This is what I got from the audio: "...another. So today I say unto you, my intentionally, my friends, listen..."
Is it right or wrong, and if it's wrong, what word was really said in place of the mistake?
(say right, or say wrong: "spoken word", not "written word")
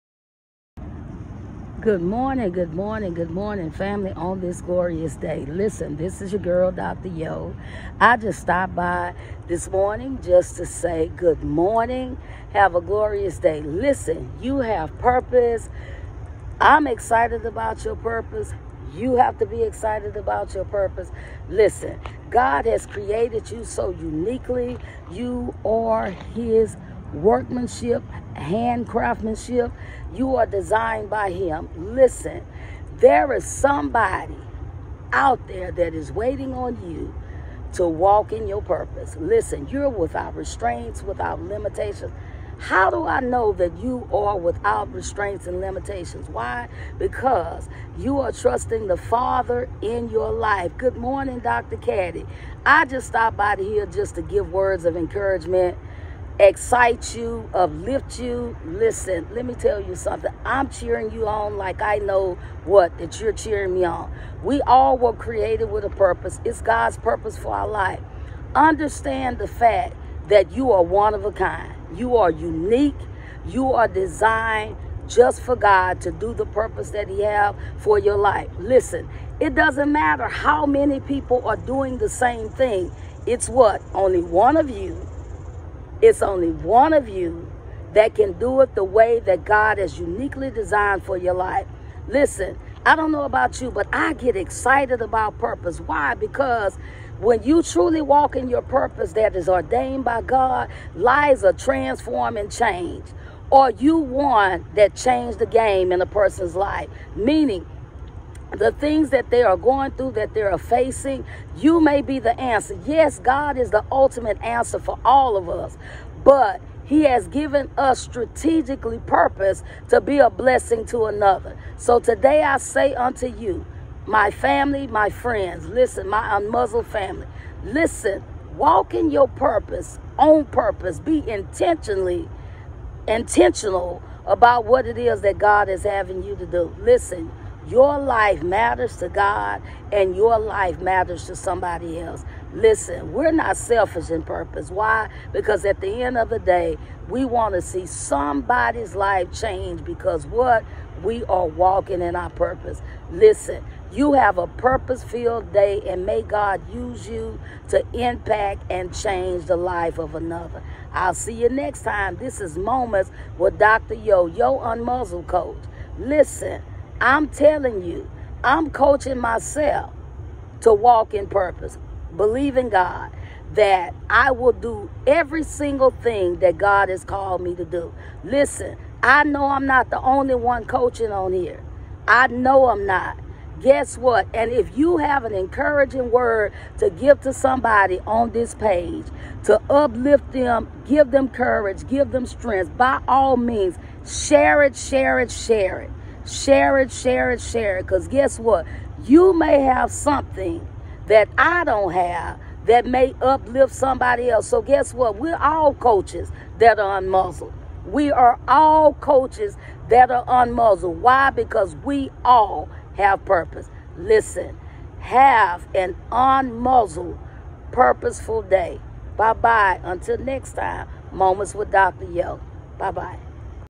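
wrong: "family", not "intentionally".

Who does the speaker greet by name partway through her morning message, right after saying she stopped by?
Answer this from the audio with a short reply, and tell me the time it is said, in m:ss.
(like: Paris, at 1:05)
Dr. Caddy, at 0:51.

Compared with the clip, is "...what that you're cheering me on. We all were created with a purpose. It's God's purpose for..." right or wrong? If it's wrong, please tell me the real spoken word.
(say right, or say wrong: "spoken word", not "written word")
right.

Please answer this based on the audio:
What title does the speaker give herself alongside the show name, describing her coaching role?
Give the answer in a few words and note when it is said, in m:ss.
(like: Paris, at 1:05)
Yo Unmuzzled Coach, at 2:44.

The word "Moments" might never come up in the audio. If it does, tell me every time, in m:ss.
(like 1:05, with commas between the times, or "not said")
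2:42, 3:41.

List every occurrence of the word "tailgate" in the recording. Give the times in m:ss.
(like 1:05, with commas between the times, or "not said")
not said.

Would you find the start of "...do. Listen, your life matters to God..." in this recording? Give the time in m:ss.
2:16.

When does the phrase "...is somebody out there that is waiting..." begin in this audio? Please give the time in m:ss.
0:33.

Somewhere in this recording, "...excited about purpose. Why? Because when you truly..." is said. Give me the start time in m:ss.
1:34.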